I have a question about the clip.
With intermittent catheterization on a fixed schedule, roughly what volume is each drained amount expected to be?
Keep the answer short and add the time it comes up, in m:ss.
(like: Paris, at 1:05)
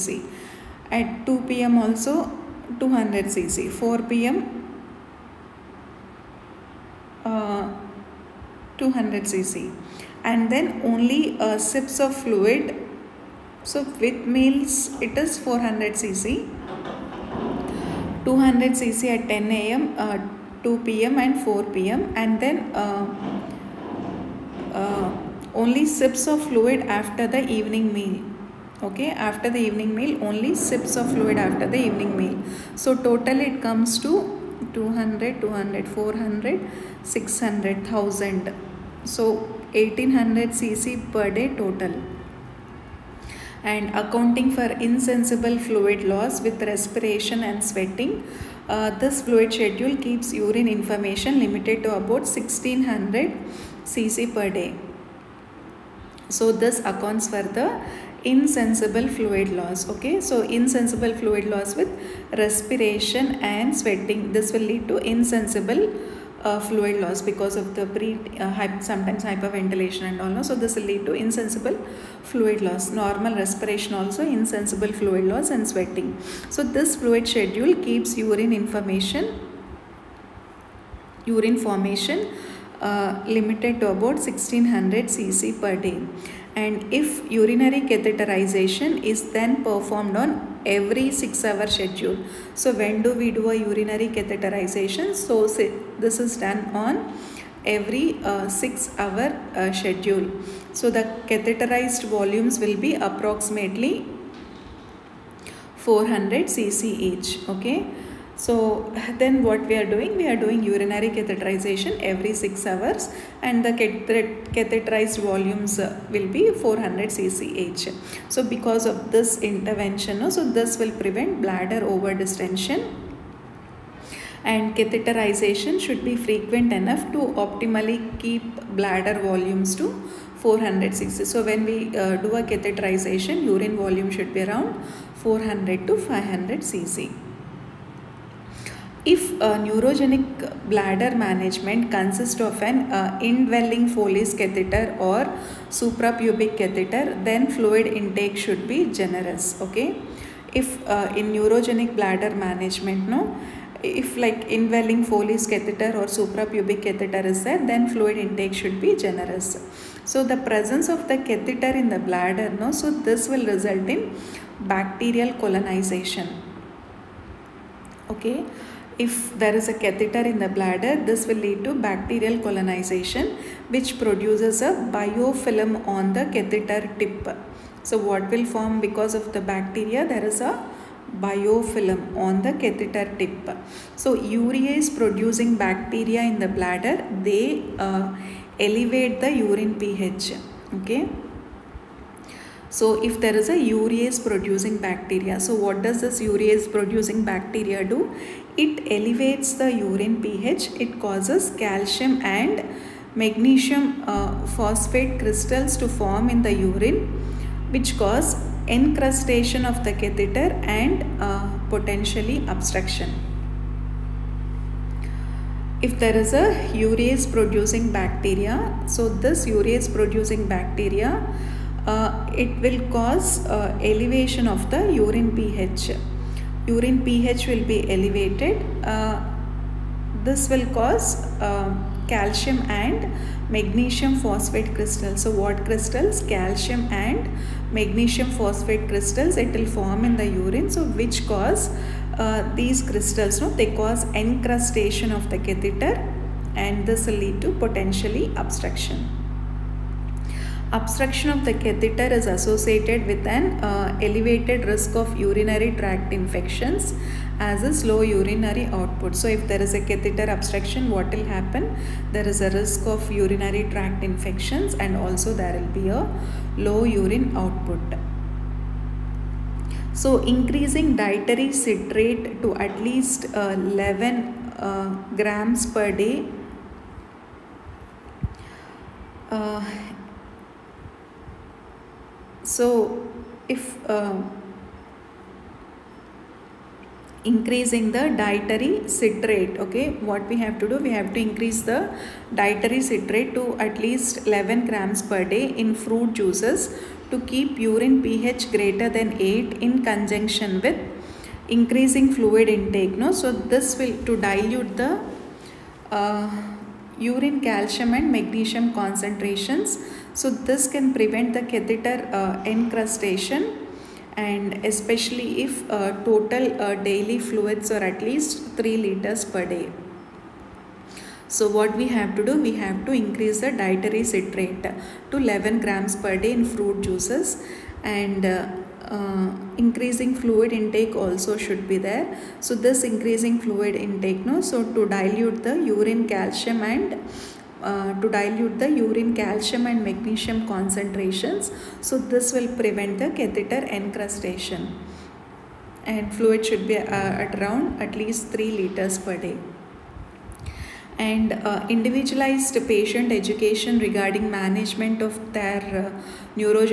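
400 cc, at 1:45.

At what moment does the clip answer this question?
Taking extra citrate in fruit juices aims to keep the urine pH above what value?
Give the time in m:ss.
4:58.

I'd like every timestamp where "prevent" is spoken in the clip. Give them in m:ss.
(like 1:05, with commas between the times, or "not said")
2:00, 5:10, 5:42.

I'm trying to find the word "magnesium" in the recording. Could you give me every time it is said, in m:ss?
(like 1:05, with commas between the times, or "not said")
3:23, 3:53, 3:57, 5:08, 5:39.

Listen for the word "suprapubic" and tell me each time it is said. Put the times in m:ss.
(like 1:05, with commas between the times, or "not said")
2:25, 2:36.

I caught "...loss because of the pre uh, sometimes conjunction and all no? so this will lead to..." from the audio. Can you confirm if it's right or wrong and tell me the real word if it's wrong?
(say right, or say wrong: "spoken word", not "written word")
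wrong: "hyperventilation", not "conjunction".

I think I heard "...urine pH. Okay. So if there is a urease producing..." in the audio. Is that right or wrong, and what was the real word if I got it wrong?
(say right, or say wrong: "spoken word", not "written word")
right.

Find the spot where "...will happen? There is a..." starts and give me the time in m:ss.
4:21.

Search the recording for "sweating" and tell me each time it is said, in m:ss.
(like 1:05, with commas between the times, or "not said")
0:47, 1:03, 1:15.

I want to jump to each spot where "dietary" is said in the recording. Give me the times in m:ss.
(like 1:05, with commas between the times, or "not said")
4:30, 4:48, 4:52, 5:23.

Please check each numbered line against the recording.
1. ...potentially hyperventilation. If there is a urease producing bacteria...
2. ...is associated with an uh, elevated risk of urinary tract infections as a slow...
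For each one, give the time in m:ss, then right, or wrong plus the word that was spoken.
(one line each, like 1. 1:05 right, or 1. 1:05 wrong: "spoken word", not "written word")
1. 3:31 wrong: "obstruction", not "hyperventilation"
2. 4:12 right.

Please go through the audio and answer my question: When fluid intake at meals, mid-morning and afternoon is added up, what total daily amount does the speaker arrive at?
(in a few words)
1800 cc.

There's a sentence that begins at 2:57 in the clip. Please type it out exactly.
So what will form because of the bacteria, there is a biofilm on the catheter tip.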